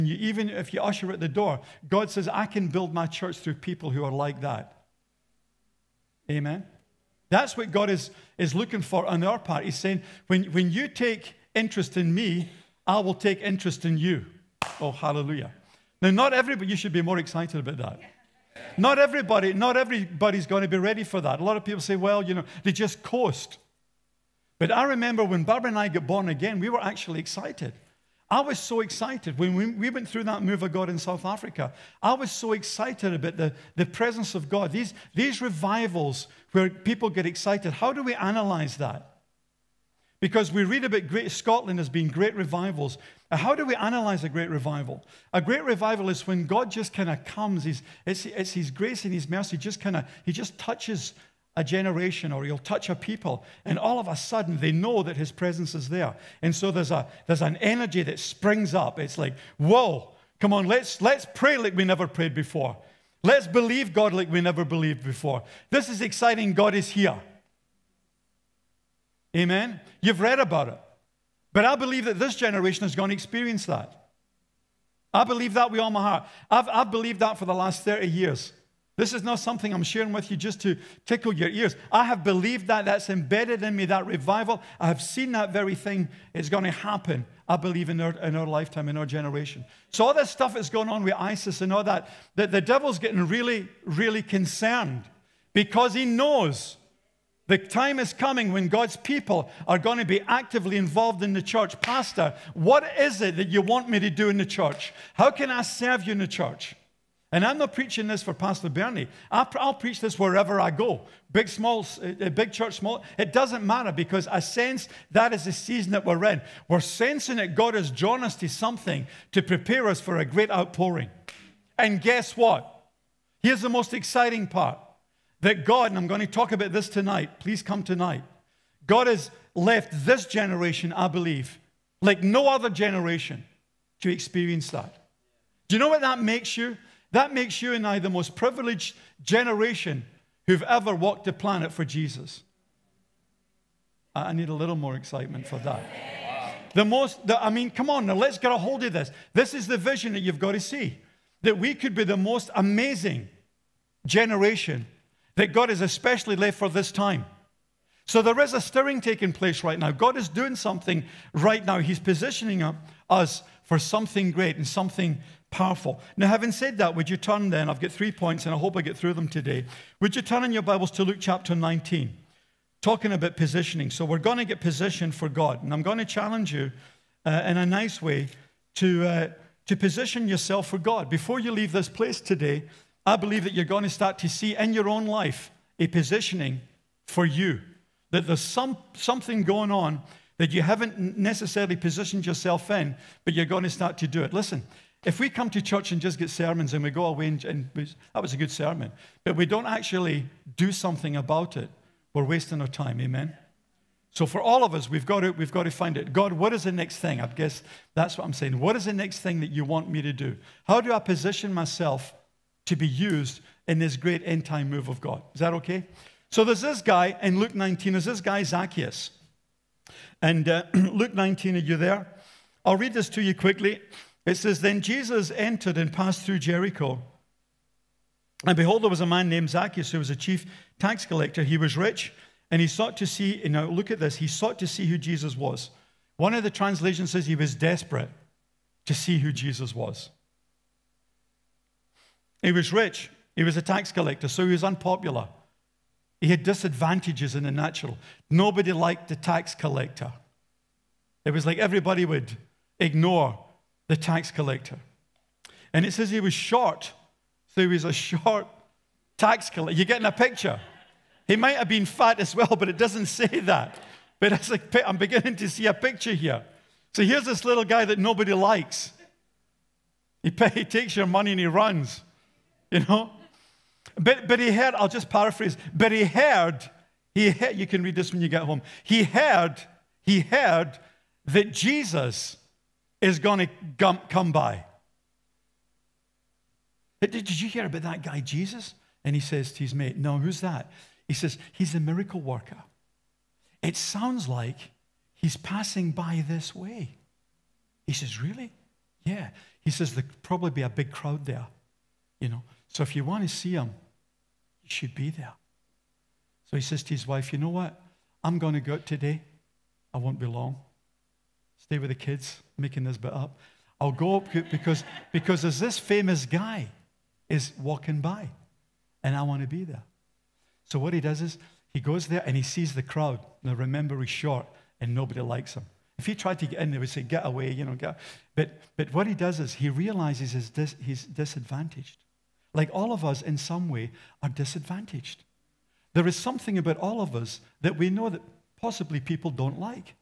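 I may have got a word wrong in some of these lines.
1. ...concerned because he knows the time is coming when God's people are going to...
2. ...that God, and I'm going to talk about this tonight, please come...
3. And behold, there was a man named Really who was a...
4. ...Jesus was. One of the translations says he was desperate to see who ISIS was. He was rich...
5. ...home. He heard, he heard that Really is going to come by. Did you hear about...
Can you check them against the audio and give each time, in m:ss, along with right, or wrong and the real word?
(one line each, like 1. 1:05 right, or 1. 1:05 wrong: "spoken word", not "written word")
1. 1:34 right
2. 2:05 right
3. 3:48 wrong: "Zacchaeus", not "Really"
4. 3:54 wrong: "Jesus", not "ISIS"
5. 4:38 wrong: "Jesus", not "Really".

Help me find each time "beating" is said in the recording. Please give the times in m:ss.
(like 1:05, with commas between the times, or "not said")
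not said.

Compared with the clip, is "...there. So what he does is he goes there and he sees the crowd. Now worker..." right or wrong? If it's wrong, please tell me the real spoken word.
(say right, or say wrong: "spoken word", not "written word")
wrong: "remember", not "worker".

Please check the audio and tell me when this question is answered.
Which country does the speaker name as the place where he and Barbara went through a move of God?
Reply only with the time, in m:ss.
0:30.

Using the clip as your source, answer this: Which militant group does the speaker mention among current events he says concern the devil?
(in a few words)
ISIS.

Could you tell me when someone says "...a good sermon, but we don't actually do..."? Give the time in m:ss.
3:18.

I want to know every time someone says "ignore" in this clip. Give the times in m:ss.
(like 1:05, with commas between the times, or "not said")
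4:12.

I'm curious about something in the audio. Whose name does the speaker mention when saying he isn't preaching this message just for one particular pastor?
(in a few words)
Pastor Bernie.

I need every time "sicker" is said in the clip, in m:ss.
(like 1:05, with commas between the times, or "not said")
not said.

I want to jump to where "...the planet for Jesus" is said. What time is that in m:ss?
2:21.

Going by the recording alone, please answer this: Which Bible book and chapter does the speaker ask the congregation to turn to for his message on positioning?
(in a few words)
Luke 19.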